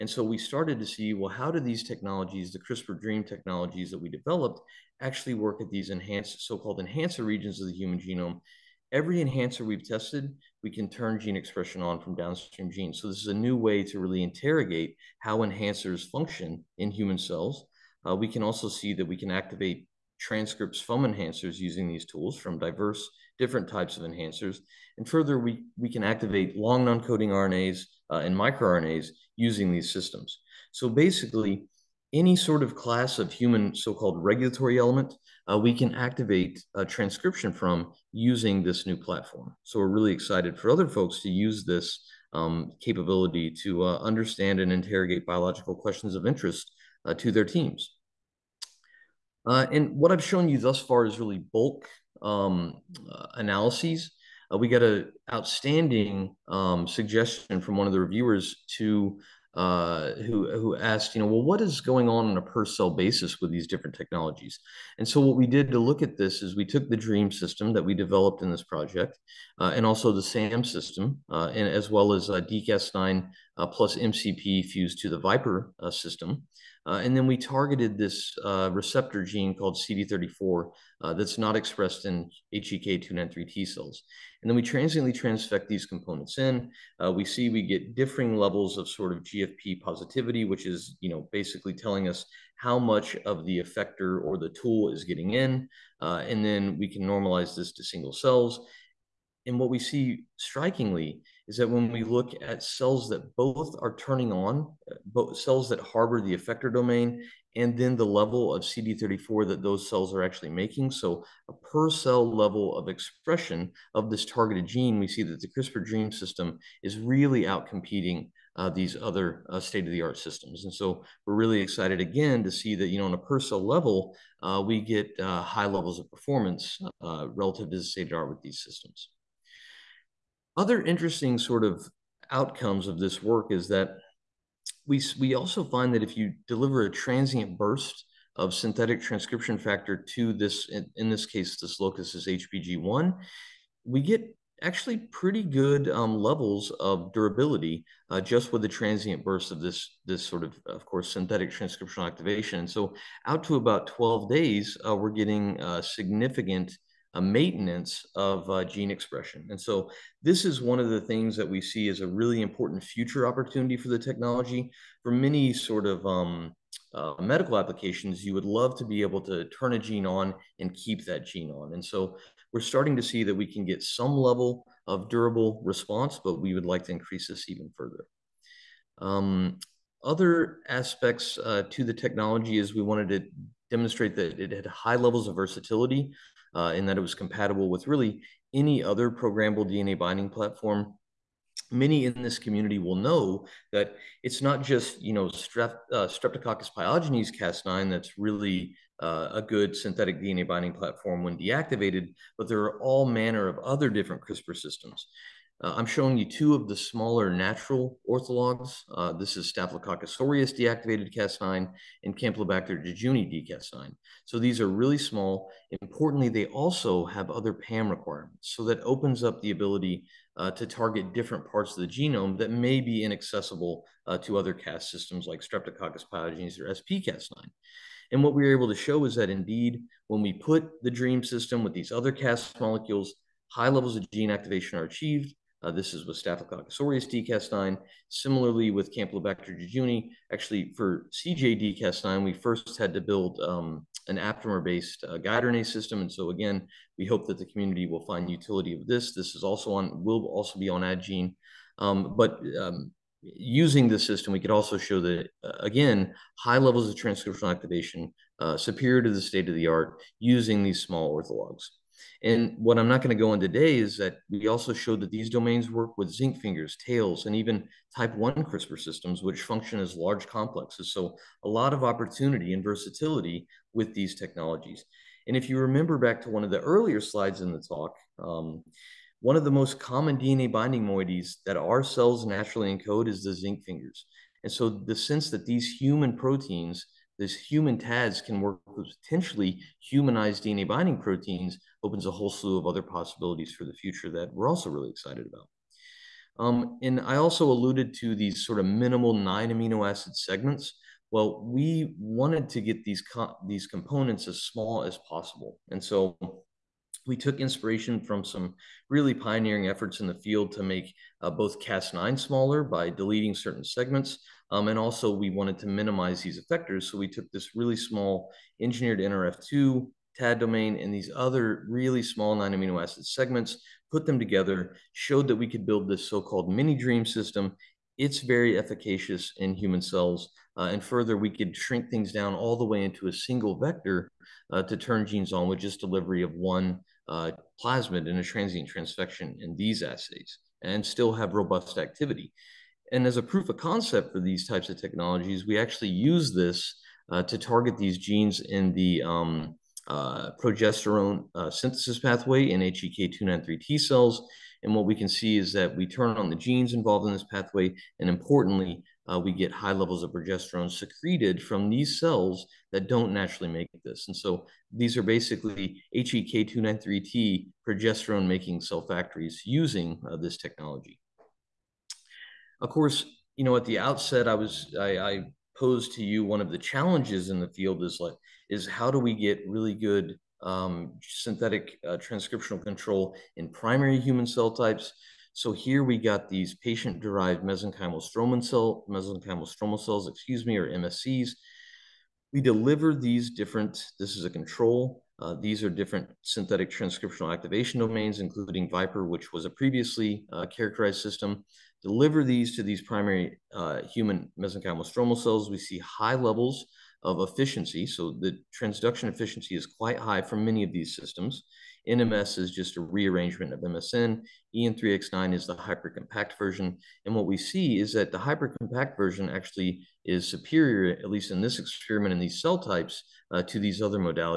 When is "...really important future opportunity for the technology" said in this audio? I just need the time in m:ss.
2:42.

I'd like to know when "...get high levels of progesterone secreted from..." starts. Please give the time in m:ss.
5:59.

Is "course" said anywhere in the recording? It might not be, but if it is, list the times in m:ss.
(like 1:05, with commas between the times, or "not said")
2:30, 6:12.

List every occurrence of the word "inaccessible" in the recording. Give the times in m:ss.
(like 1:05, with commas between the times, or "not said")
3:43.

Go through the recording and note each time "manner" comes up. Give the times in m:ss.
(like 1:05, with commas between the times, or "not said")
3:23.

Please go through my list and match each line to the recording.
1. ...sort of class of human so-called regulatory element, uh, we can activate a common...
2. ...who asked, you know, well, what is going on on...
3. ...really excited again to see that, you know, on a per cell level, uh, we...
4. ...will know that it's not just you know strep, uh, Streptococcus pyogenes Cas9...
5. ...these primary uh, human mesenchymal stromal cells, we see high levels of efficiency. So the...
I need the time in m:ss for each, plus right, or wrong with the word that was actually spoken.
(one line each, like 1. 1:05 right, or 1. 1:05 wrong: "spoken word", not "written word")
1. 0:32 wrong: "transcription", not "common"
2. 1:00 right
3. 2:01 right
4. 3:12 right
5. 6:42 right.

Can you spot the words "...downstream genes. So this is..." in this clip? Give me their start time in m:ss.
0:12.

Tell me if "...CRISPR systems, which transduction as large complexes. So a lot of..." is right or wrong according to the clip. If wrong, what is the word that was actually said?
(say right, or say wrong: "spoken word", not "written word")
wrong: "function", not "transduction".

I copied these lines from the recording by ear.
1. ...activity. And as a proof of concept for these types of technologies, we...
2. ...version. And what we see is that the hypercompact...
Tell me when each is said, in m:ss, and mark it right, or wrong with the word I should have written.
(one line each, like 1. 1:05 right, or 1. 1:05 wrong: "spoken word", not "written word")
1. 5:41 right
2. 6:56 right.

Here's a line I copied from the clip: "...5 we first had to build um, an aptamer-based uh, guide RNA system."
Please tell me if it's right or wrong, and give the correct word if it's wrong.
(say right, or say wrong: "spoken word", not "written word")
wrong: "9", not "5".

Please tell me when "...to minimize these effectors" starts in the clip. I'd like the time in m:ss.
5:15.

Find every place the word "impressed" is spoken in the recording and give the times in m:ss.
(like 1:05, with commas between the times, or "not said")
not said.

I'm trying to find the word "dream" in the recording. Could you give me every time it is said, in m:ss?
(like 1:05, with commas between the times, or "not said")
0:03, 1:06, 3:50, 5:26.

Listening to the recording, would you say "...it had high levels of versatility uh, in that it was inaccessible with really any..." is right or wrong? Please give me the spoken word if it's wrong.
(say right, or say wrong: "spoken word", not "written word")
wrong: "compatible", not "inaccessible".